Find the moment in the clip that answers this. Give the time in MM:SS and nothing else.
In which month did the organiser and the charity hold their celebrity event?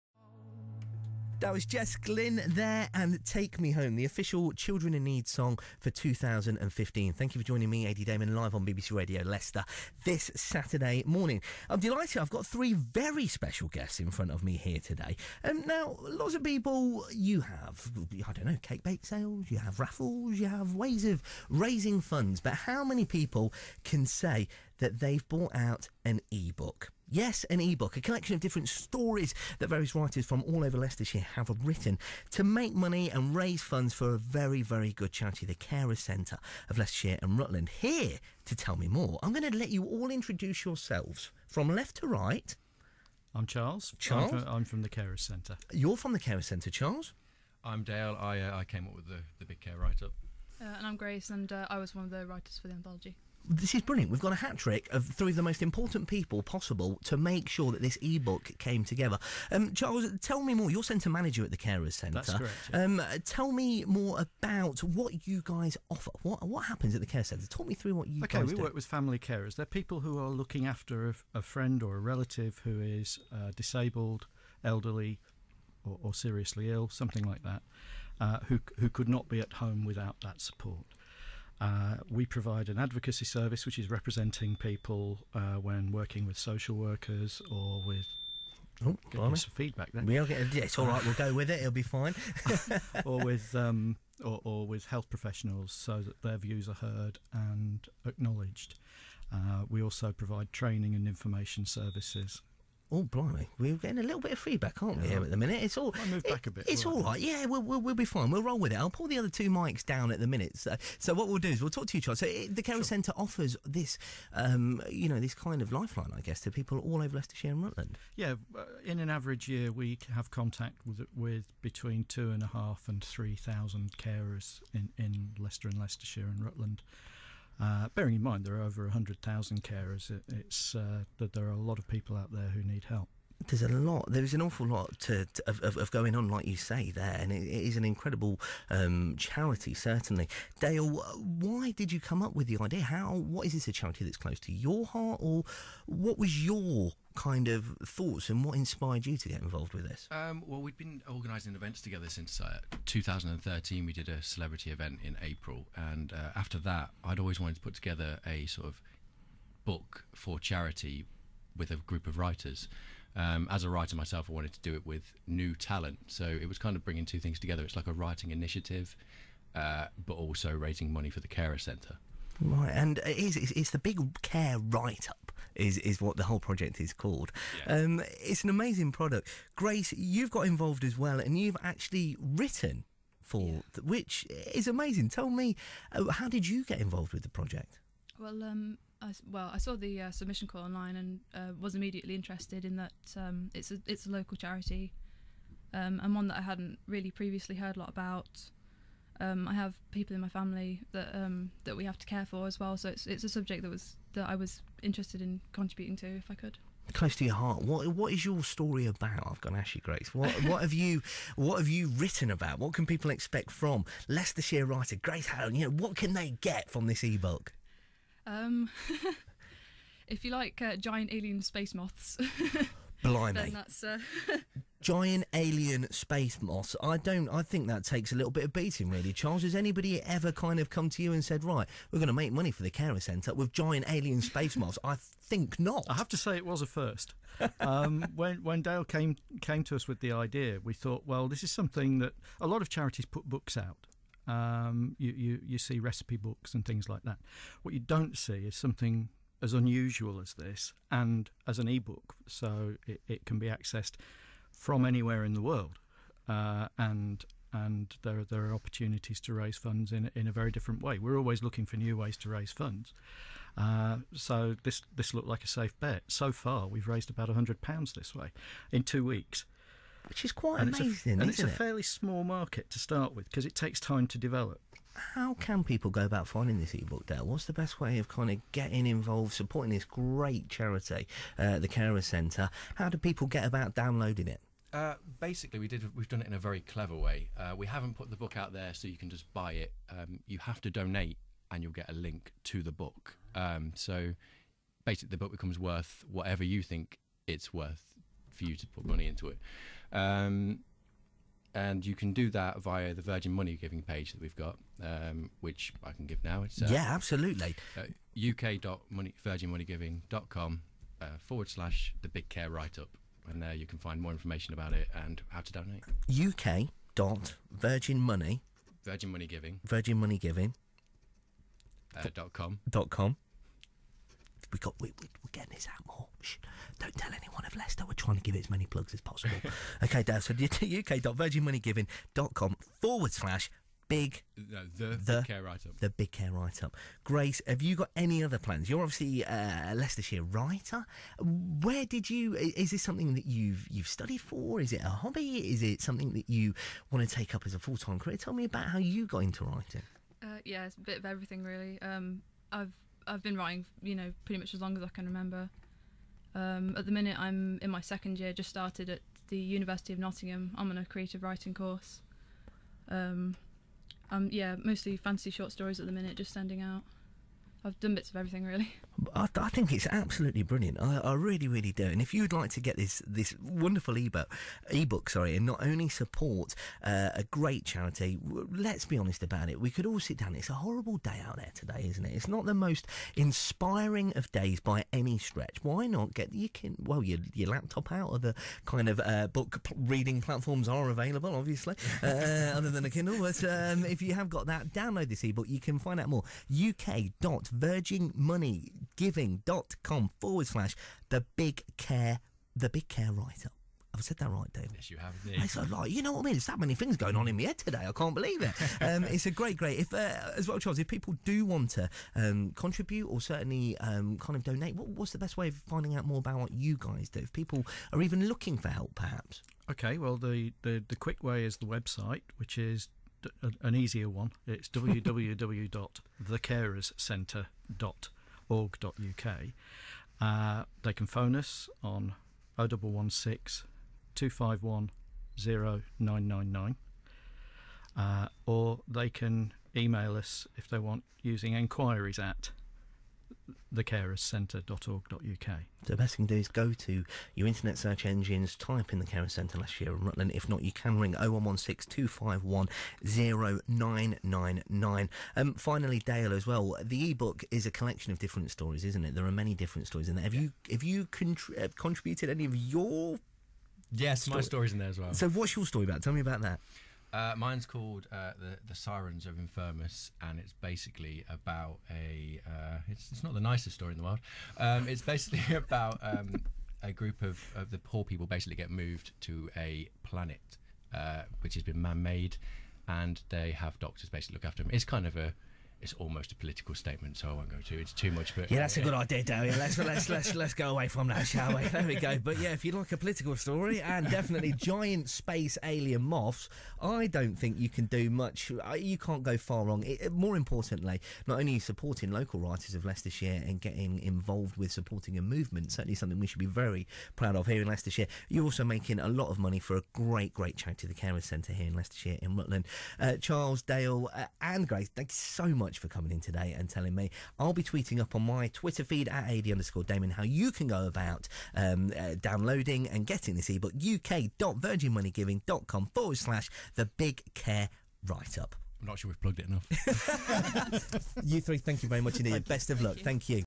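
02:35.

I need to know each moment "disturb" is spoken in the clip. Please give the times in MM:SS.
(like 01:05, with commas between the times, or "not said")
not said.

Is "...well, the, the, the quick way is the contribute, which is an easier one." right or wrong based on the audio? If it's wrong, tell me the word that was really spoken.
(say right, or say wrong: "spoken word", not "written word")
wrong: "website", not "contribute".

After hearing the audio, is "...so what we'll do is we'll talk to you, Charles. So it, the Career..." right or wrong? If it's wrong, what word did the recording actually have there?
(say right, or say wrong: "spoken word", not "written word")
right.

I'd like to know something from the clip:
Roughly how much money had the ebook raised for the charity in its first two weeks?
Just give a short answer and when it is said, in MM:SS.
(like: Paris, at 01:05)
100 pounds, at 04:27.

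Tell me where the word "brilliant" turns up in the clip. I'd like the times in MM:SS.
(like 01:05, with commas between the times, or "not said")
00:53, 06:10.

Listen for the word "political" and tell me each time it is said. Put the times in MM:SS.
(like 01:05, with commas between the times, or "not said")
08:06, 08:12.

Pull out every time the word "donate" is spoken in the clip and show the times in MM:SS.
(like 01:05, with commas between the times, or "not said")
04:50, 05:15, 06:54.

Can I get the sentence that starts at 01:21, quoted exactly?
Uh, we provide an advocacy service which is representing people uh, when working with social workers or with Oh, some feedback then.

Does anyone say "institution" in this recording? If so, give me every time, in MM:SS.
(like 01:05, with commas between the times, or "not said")
not said.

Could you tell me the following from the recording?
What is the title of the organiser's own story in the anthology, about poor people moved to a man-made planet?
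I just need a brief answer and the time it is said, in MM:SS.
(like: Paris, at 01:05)
The Sirens of Infirmus, at 07:48.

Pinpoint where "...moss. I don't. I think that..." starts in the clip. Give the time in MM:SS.
03:46.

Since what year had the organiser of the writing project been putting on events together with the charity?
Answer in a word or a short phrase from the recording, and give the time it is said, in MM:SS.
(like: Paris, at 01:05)
2013, at 02:32.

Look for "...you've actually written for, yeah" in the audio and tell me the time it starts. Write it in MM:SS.
03:01.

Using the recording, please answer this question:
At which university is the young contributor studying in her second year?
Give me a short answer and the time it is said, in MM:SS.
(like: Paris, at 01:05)
University of Nottingham, at 05:59.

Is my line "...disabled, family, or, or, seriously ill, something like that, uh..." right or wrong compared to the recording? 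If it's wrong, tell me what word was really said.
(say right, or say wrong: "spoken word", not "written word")
wrong: "elderly", not "family".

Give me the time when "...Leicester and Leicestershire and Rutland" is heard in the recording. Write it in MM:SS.
02:05.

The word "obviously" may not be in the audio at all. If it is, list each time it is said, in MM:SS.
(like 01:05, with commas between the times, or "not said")
05:38, 06:31.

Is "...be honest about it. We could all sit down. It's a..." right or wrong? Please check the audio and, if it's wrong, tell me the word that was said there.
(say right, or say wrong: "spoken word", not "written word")
right.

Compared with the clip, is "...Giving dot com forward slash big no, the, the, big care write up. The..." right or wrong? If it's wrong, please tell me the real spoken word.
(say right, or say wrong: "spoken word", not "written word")
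right.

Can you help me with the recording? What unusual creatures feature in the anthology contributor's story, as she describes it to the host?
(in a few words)
Giant alien space moths.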